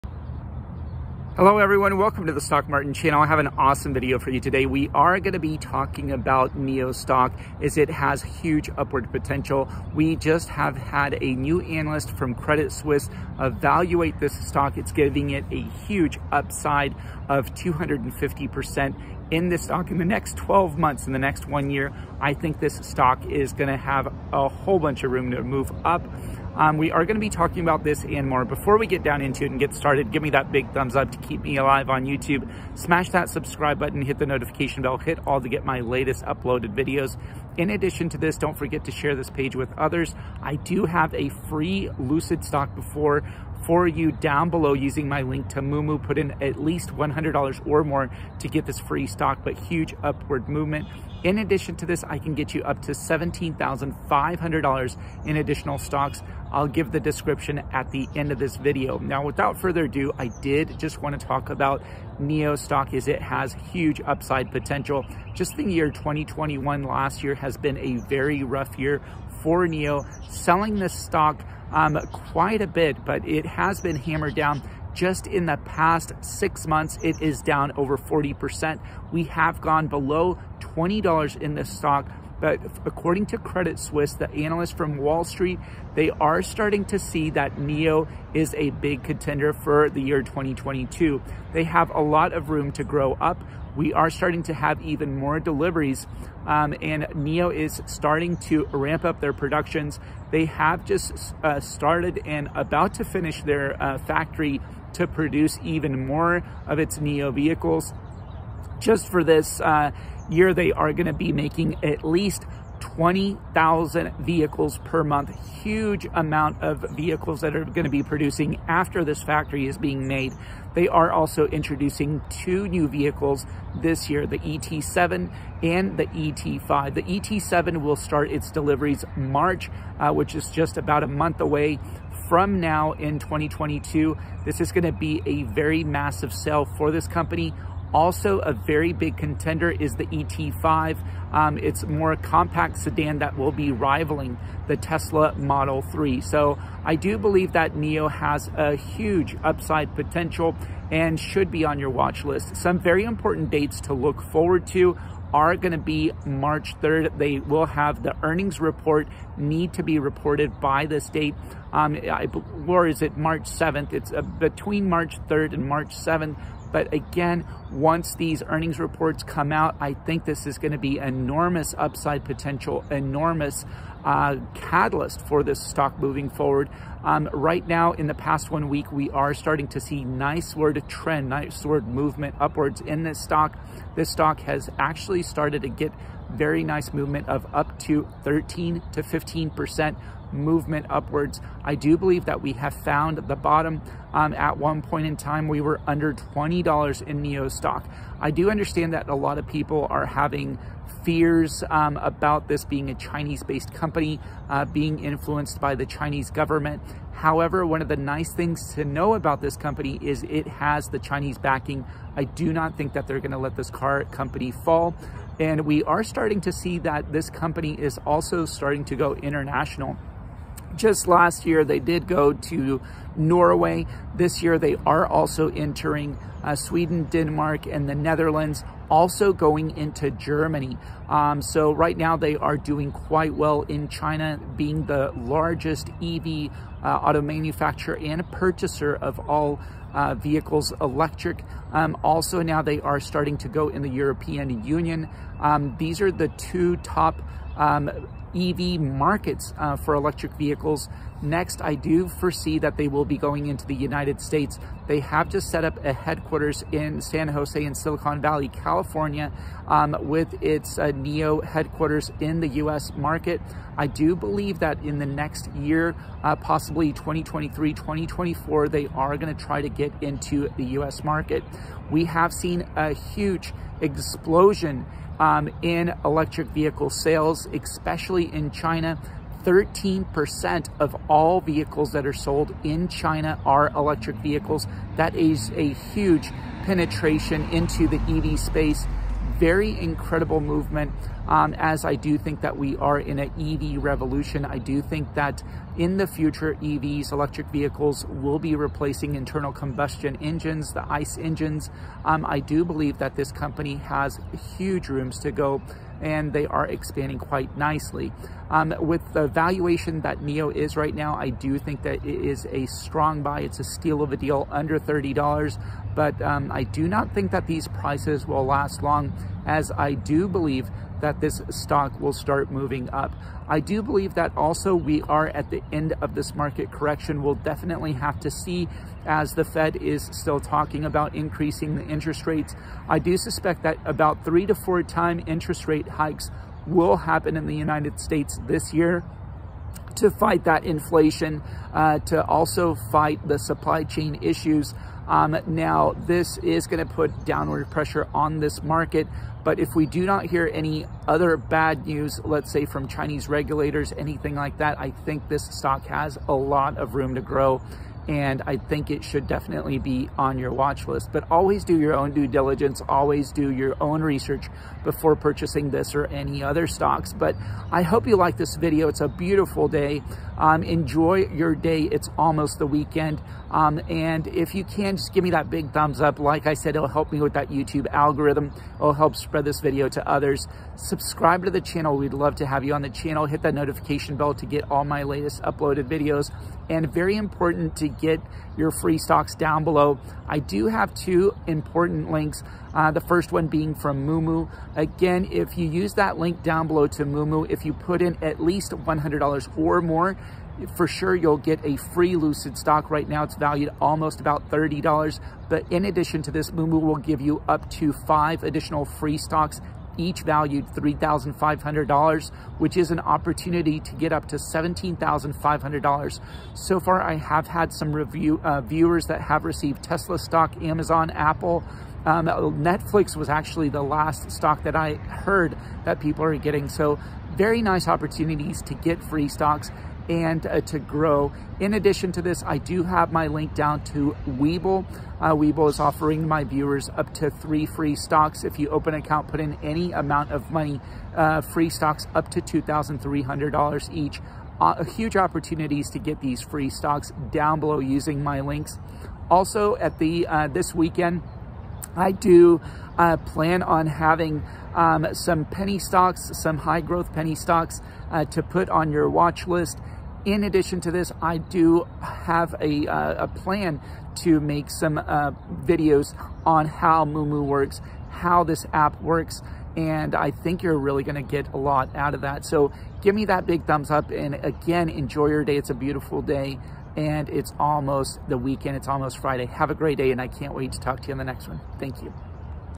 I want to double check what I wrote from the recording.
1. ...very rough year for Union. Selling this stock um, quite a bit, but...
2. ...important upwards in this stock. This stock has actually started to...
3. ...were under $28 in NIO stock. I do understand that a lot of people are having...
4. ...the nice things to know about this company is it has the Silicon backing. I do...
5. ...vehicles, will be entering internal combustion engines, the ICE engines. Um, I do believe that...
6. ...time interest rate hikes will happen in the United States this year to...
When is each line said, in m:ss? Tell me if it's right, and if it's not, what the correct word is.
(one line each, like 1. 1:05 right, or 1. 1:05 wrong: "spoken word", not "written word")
1. 1:08 wrong: "NIO", not "Union"
2. 3:01 wrong: "movement", not "important"
3. 3:15 wrong: "20", not "28"
4. 3:27 wrong: "Chinese", not "Silicon"
5. 4:57 wrong: "replacing", not "entering"
6. 5:34 right.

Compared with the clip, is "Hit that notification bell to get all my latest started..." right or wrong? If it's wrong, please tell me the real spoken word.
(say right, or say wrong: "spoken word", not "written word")
wrong: "uploaded", not "started".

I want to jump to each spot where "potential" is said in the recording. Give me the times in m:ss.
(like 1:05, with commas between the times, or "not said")
0:09, 1:04, 2:29, 2:52.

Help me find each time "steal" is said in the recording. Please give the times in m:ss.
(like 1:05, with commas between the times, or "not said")
5:13.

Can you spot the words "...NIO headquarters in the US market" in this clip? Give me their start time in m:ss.
4:20.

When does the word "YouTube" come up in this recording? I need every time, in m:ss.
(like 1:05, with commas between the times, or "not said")
0:32, 6:17.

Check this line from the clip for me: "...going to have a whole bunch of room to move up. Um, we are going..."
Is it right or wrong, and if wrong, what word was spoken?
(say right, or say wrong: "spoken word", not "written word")
right.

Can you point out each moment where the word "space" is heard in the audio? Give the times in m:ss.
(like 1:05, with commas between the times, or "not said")
4:48.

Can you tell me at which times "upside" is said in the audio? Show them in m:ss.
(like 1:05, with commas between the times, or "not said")
0:16, 1:04, 2:29, 2:51.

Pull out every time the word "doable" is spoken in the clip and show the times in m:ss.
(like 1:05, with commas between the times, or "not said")
not said.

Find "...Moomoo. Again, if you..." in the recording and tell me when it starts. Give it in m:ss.
6:34.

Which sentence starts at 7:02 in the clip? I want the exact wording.
Um, Netflix was actually the last stock that I heard that people are getting.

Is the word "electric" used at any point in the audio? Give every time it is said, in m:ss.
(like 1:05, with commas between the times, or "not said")
4:00, 4:09, 4:36, 4:43, 4:57.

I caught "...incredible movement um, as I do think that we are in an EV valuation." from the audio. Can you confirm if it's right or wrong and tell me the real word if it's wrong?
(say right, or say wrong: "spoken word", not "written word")
wrong: "revolution", not "valuation".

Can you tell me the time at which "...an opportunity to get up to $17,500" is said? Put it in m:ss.
6:52.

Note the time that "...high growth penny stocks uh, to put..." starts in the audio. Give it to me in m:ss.
7:36.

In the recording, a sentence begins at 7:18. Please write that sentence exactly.
If you open an account, put in any amount of money, uh, free stocks up to $2,300 each.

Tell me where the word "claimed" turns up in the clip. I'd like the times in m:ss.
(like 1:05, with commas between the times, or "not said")
not said.